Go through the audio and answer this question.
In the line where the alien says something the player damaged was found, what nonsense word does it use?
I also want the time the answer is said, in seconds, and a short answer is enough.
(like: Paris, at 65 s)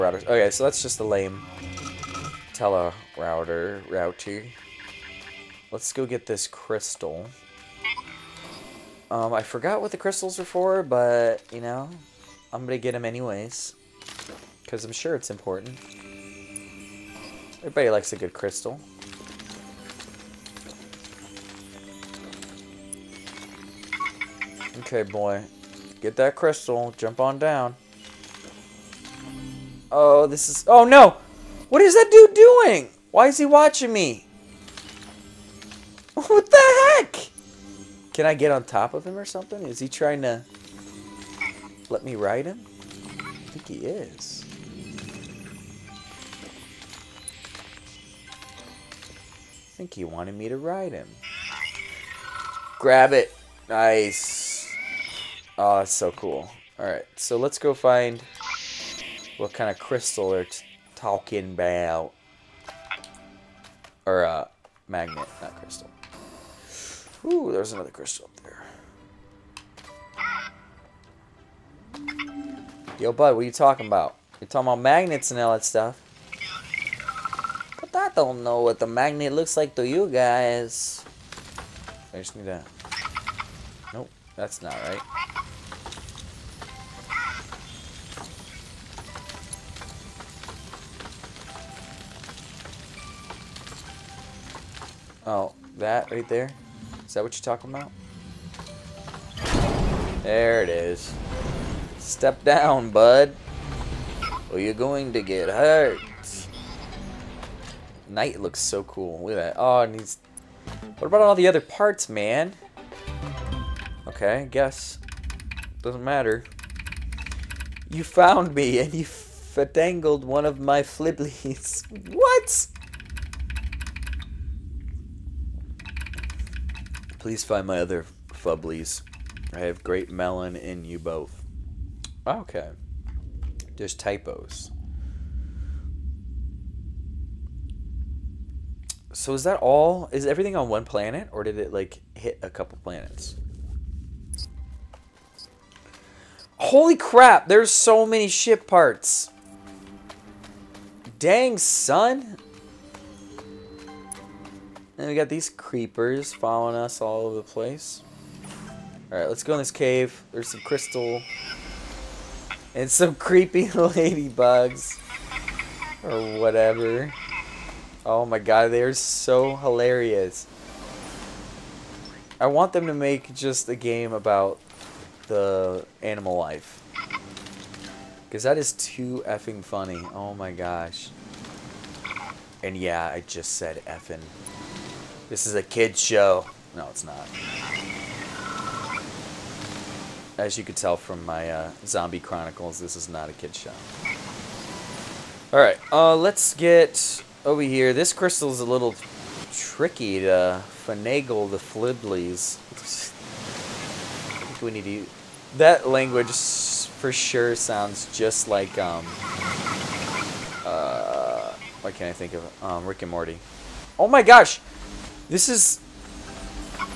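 flibblies, at 120 s.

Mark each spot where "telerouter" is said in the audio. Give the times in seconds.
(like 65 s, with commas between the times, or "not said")
2 s.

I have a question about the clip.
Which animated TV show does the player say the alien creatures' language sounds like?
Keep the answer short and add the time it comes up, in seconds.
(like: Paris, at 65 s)
Rick and Morty, at 212 s.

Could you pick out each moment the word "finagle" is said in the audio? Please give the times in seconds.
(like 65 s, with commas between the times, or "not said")
200 s.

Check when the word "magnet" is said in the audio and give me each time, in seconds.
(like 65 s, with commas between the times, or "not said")
64 s, 74 s, 78 s.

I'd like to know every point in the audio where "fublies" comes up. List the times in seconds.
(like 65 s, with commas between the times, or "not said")
128 s.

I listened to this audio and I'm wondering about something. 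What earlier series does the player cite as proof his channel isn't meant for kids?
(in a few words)
Zombie Chronicles.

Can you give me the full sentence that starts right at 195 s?
Alright, uh, let's get over here.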